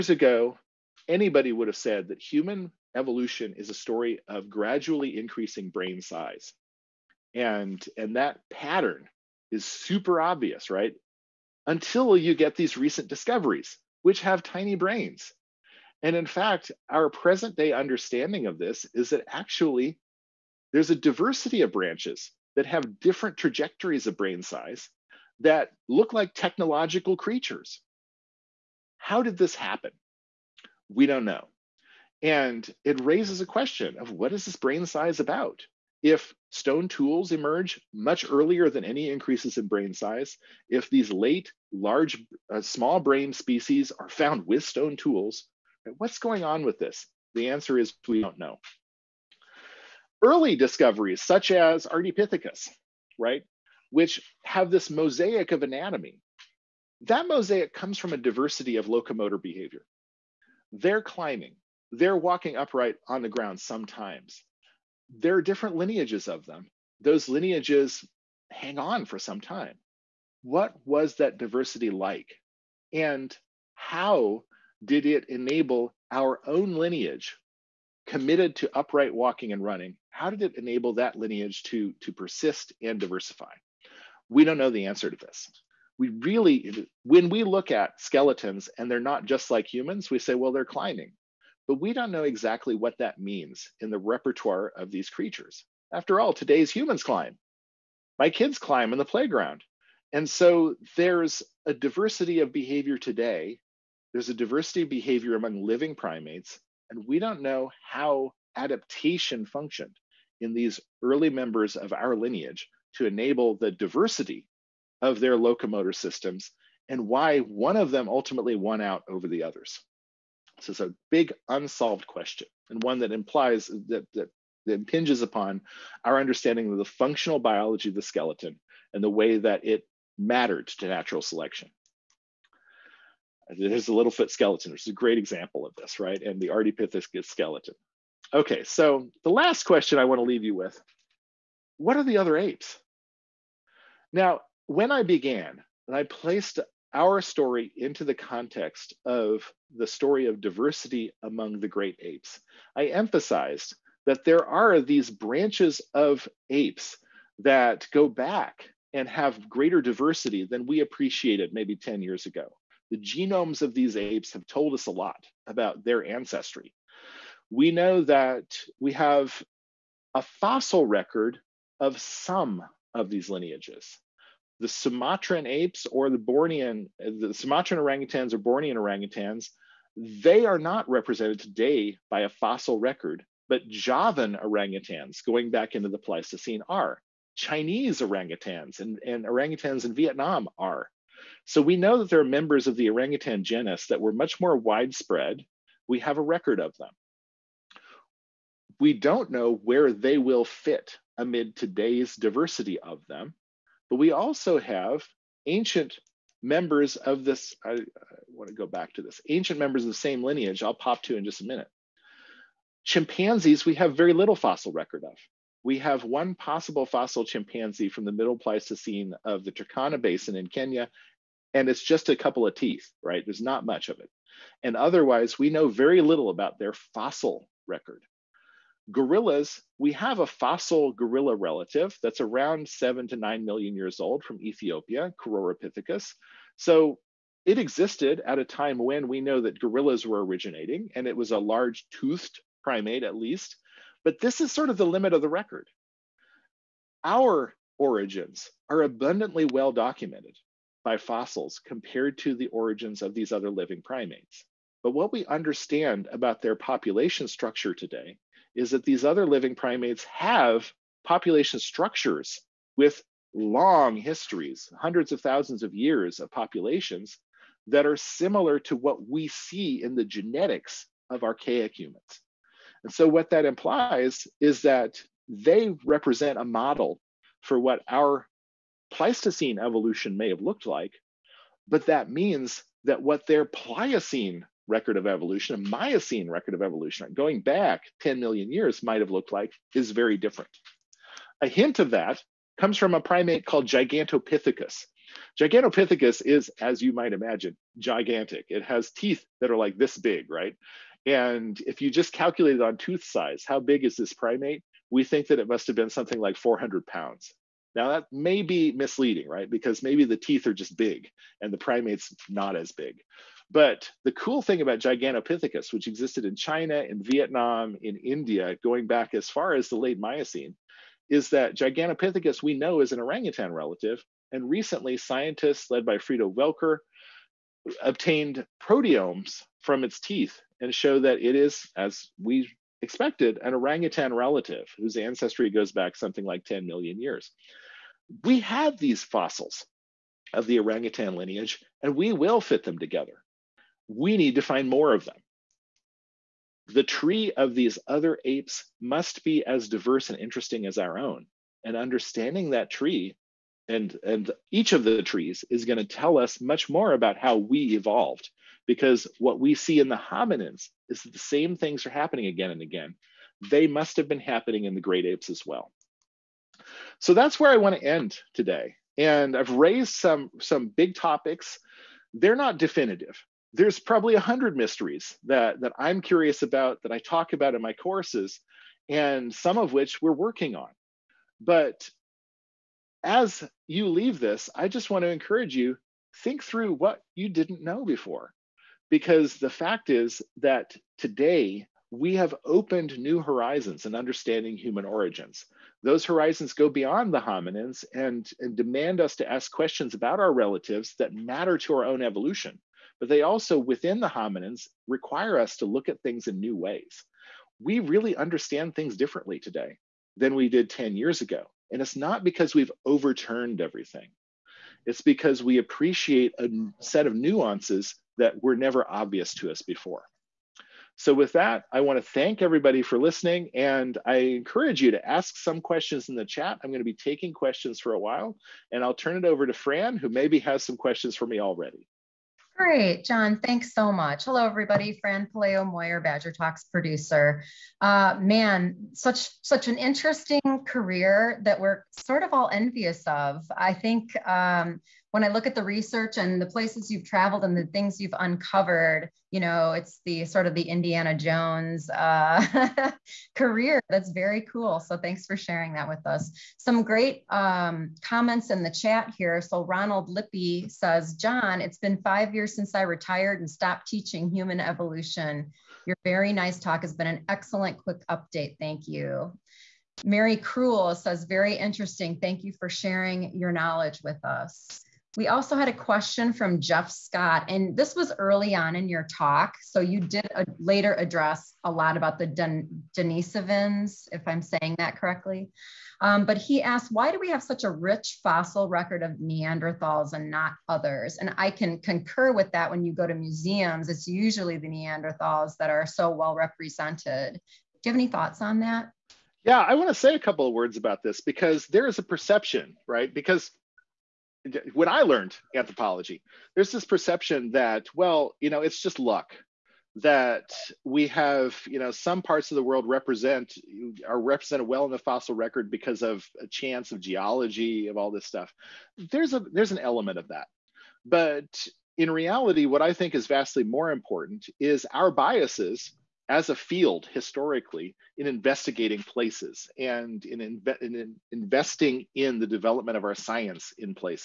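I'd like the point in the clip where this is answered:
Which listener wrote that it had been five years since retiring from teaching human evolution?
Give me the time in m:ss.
7:39.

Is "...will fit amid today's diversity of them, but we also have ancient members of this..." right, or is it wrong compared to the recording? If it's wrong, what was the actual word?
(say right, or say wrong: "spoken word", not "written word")
right.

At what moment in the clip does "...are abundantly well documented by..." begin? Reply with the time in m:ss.
4:08.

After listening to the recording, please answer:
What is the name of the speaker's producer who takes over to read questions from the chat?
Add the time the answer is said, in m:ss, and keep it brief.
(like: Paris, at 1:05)
Fran Paleo Moyer, at 7:14.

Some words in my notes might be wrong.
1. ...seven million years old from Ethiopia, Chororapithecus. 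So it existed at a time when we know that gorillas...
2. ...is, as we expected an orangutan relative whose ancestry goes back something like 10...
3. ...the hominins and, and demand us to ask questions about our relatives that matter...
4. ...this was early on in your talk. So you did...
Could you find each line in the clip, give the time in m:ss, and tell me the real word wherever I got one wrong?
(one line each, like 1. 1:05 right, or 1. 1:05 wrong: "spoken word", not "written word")
1. 3:53 wrong: "nine", not "seven"
2. 5:31 right
3. 6:37 right
4. 7:57 right.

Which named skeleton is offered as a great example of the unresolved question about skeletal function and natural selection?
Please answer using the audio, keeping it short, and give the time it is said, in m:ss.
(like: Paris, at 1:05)
Littlefoot, at 2:13.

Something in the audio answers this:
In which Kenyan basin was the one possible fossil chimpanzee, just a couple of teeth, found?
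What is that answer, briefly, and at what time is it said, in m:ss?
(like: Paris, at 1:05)
Turkana Basin, at 3:39.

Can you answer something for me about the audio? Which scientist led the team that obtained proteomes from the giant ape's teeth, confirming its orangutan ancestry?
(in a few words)
Frido Welker.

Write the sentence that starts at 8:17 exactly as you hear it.
Do you have any thoughts on that?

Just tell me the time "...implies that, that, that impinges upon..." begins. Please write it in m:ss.
2:03.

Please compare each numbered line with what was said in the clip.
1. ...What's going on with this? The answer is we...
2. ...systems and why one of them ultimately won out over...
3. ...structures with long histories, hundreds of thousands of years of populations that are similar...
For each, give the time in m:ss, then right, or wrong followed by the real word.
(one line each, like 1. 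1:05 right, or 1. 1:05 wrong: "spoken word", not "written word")
1. 0:45 right
2. 1:55 right
3. 4:21 right.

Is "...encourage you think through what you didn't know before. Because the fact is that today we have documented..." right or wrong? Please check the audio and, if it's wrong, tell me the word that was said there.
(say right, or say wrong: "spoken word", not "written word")
wrong: "opened", not "documented".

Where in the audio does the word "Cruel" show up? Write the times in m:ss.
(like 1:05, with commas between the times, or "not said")
7:50.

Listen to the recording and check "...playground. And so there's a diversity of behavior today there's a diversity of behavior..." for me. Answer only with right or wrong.
right.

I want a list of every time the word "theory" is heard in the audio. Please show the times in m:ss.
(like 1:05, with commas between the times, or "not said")
not said.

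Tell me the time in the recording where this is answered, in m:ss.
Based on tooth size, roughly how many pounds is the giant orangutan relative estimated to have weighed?
5:06.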